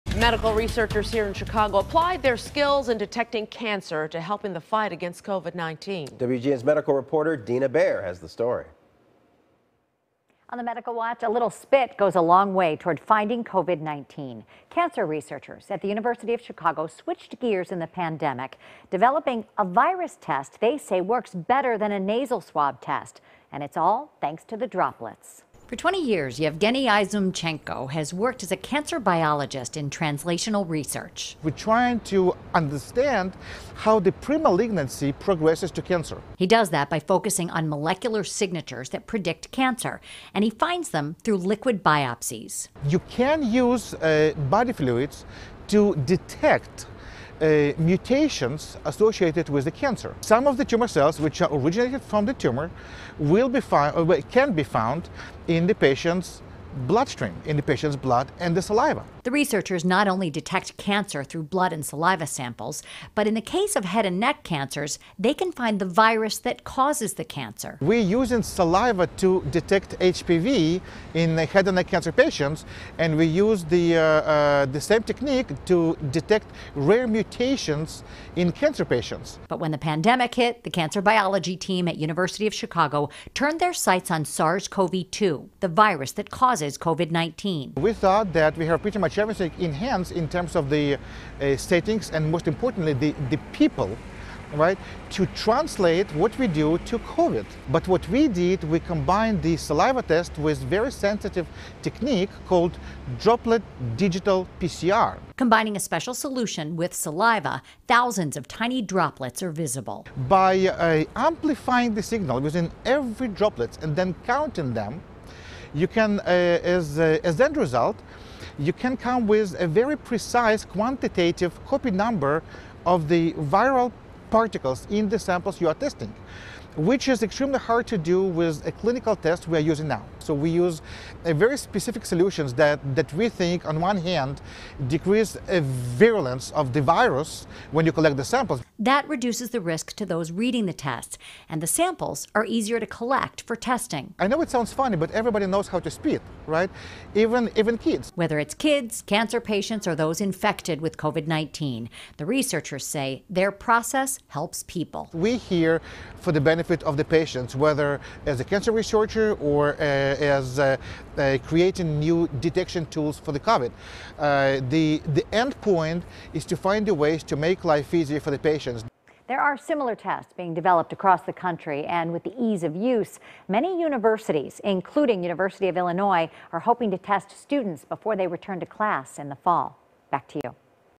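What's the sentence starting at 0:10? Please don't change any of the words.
On the medical watch, a little spit goes a long way toward finding COVID-19.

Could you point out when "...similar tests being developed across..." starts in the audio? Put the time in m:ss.
2:49.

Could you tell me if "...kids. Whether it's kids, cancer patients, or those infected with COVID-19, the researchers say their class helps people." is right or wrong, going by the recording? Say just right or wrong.
wrong.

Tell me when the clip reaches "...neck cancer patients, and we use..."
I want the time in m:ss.
1:11.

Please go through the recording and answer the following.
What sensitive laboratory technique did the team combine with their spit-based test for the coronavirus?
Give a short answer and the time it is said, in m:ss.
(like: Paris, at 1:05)
droplet digital PCR, at 1:43.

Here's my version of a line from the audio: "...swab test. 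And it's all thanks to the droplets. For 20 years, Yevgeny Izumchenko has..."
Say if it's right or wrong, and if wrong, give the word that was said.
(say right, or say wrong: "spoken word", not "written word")
right.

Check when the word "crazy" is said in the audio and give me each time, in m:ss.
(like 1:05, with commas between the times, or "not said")
not said.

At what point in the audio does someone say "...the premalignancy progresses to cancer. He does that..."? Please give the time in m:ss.
0:34.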